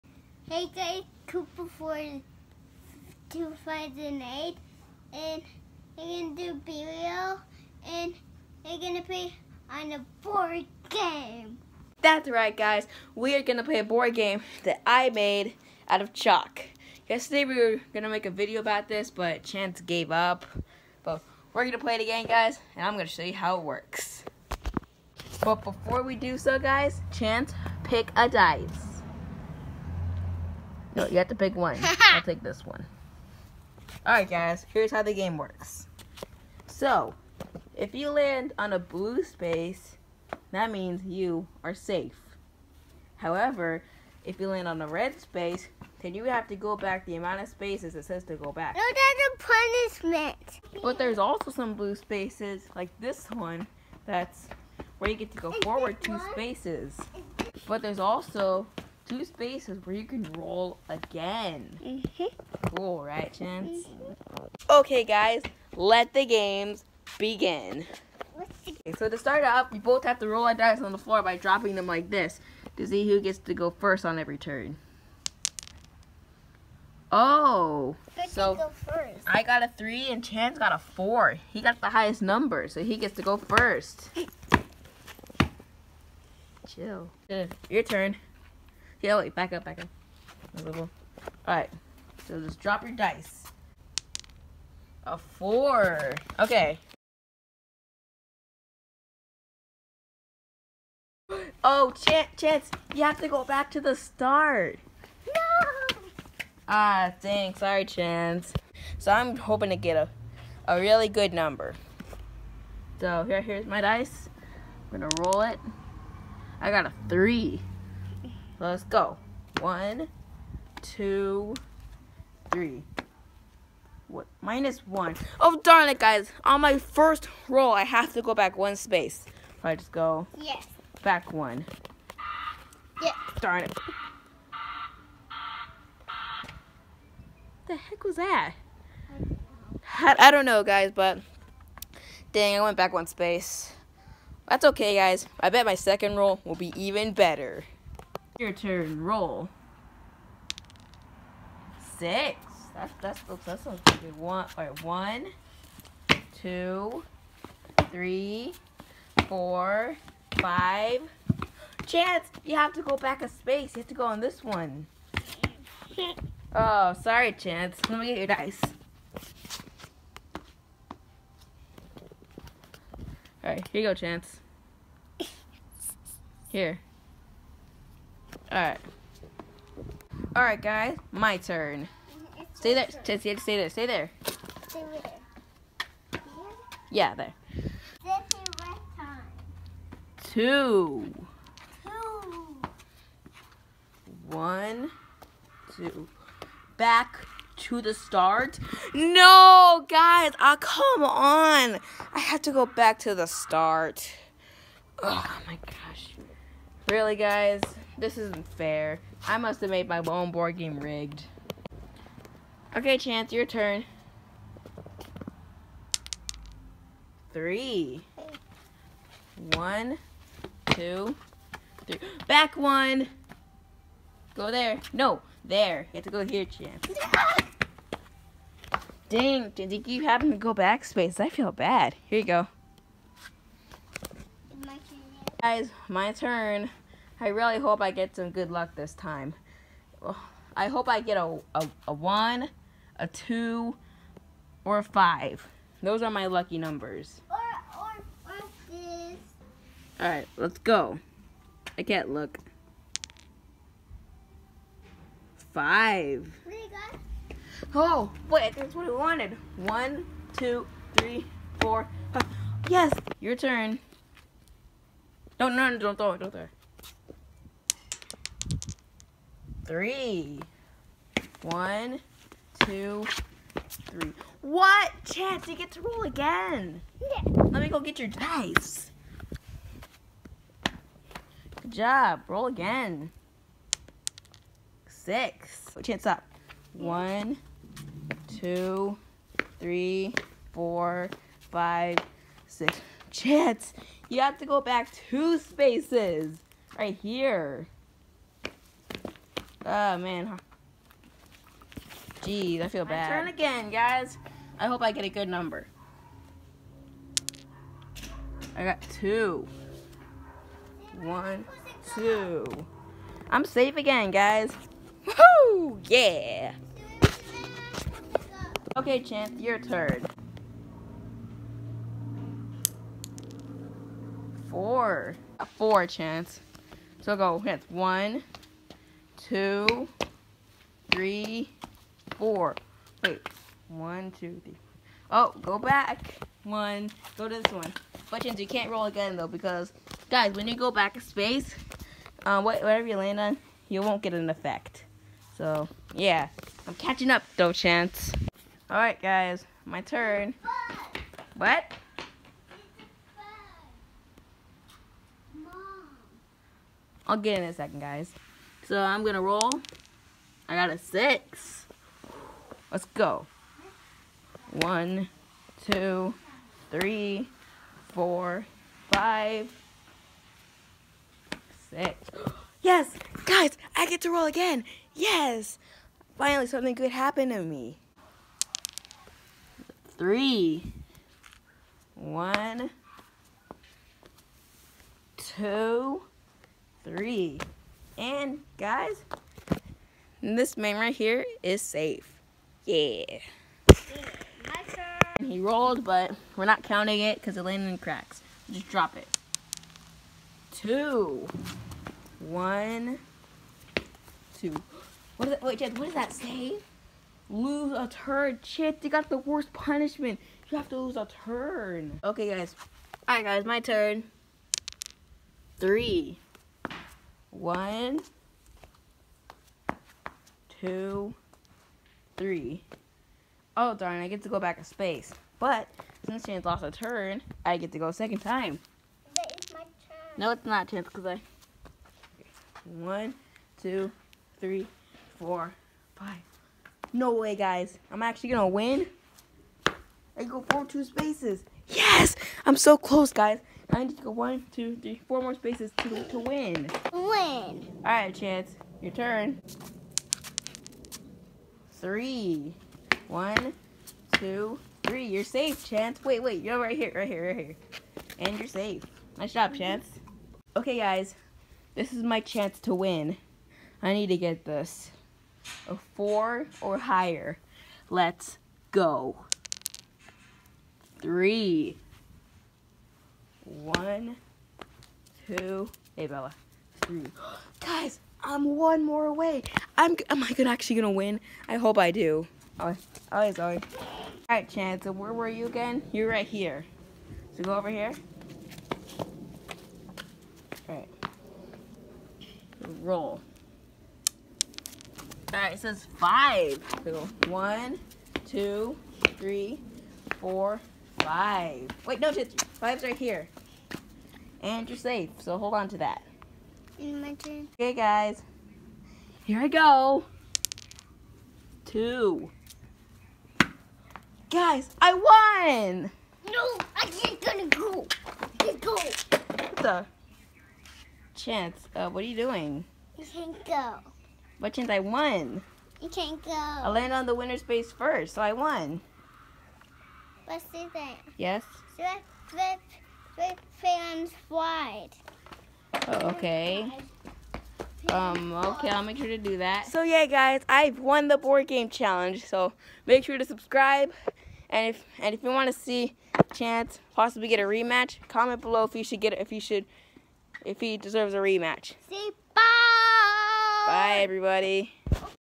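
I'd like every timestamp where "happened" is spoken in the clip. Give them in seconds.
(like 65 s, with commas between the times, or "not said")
376 s.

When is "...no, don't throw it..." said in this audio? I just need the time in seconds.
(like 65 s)
265 s.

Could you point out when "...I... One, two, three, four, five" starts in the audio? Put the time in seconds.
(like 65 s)
431 s.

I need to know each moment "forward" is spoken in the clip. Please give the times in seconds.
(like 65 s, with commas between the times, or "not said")
55 s, 440 s.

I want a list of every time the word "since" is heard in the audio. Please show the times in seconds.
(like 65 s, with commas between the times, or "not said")
426 s.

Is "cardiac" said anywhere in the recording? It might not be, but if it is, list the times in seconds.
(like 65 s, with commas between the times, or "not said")
not said.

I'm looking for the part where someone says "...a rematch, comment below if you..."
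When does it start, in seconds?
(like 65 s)
547 s.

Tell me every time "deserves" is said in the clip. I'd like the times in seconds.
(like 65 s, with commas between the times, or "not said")
550 s.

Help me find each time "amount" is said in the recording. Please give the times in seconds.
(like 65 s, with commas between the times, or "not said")
47 s.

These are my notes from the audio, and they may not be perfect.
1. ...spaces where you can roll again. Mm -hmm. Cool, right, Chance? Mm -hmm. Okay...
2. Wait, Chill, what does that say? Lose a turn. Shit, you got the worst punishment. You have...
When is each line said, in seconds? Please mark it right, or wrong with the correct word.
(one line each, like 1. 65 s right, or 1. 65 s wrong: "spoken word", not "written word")
1. 59 s right
2. 405 s wrong: "Jed", not "Chill".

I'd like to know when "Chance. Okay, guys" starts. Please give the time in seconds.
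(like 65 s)
459 s.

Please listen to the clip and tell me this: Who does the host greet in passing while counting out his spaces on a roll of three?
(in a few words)
Bella.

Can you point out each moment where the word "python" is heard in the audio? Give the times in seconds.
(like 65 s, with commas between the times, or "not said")
not said.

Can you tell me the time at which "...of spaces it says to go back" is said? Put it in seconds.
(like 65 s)
47 s.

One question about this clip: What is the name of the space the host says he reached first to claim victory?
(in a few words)
Winner space.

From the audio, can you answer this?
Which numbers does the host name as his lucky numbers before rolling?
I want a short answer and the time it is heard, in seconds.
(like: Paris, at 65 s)
1, 2, or 5, at 241 s.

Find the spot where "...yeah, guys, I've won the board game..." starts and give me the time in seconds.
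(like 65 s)
539 s.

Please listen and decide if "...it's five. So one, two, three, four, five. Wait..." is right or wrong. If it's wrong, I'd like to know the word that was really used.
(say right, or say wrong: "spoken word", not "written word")
right.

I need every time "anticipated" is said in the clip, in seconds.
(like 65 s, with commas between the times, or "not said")
not said.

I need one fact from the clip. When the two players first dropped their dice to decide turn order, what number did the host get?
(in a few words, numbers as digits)
3.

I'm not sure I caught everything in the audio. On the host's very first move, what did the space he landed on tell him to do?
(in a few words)
Minus one.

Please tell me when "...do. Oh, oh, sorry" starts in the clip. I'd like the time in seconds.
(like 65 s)
481 s.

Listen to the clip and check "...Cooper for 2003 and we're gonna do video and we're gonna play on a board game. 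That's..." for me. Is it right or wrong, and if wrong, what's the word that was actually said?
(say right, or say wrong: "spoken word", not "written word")
wrong: "2008", not "2003".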